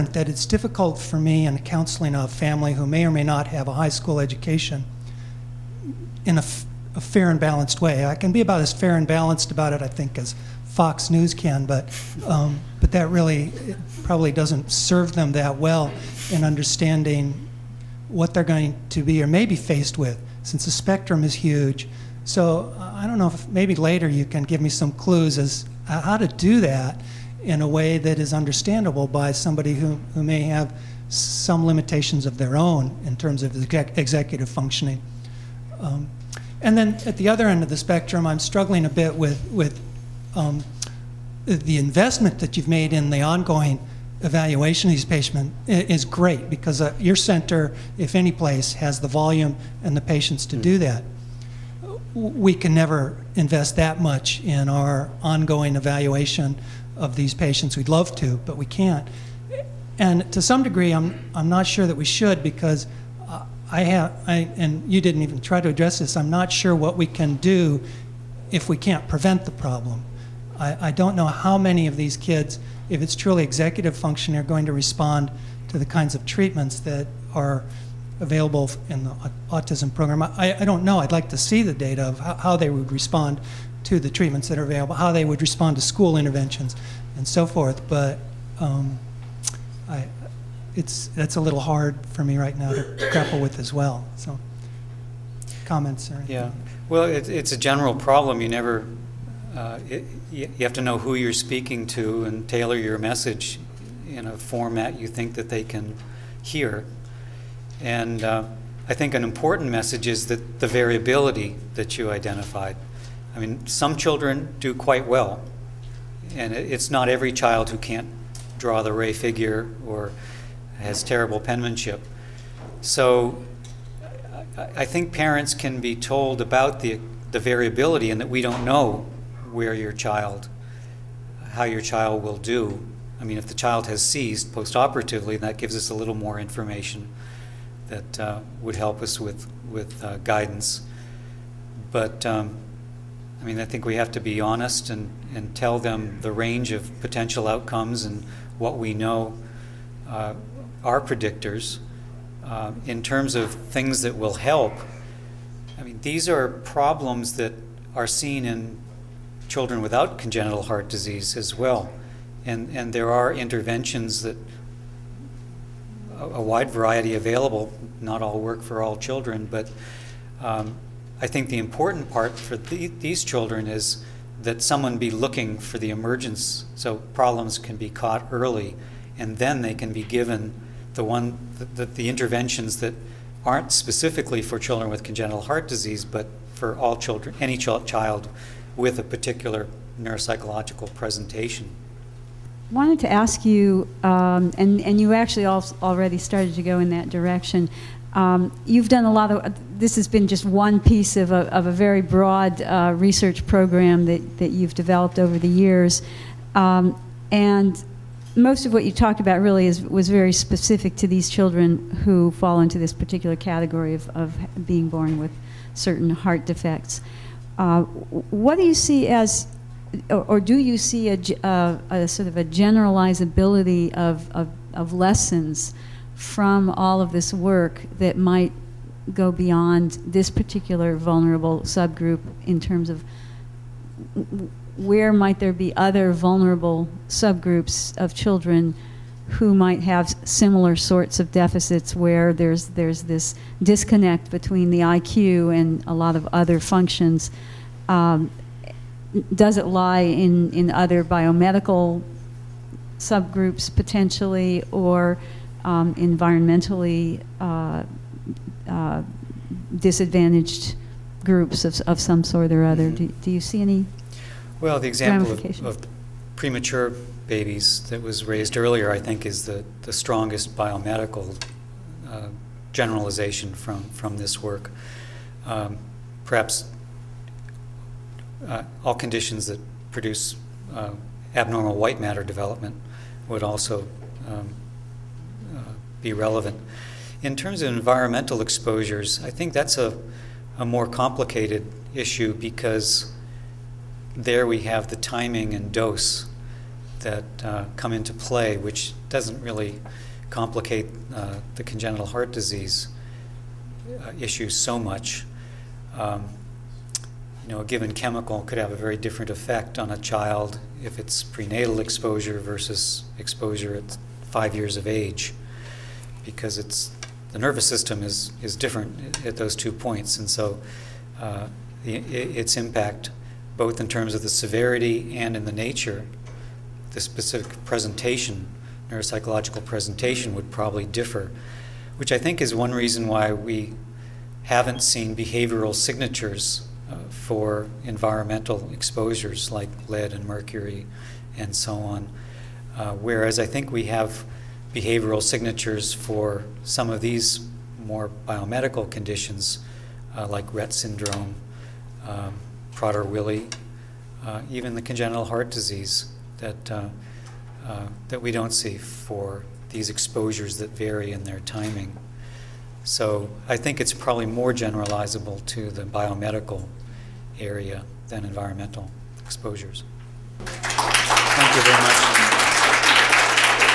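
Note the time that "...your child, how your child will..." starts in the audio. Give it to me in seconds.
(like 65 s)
129 s.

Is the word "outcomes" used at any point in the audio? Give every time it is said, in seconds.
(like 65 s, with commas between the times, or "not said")
147 s.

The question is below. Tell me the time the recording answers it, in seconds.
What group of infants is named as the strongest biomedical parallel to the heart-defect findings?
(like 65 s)
266 s.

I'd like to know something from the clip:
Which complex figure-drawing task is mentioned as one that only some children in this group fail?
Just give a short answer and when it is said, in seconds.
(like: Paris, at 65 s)
Rey figure, at 118 s.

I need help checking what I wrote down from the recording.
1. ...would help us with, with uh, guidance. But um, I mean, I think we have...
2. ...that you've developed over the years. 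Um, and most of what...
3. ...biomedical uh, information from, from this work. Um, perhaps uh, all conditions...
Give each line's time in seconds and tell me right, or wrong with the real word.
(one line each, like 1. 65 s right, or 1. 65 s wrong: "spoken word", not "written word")
1. 138 s right
2. 204 s right
3. 270 s wrong: "generalization", not "information".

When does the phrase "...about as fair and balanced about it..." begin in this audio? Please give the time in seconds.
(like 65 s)
8 s.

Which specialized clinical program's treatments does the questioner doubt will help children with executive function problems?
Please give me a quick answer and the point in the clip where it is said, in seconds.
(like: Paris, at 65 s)
autism program, at 79 s.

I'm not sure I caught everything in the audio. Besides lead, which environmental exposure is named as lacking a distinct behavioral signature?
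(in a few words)
mercury.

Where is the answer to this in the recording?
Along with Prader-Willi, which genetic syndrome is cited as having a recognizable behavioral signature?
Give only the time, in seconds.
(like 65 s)
350 s.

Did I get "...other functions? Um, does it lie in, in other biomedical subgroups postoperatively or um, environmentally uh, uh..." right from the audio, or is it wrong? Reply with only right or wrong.
wrong.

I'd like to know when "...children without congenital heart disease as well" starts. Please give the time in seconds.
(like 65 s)
159 s.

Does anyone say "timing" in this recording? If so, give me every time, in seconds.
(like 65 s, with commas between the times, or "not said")
294 s, 361 s.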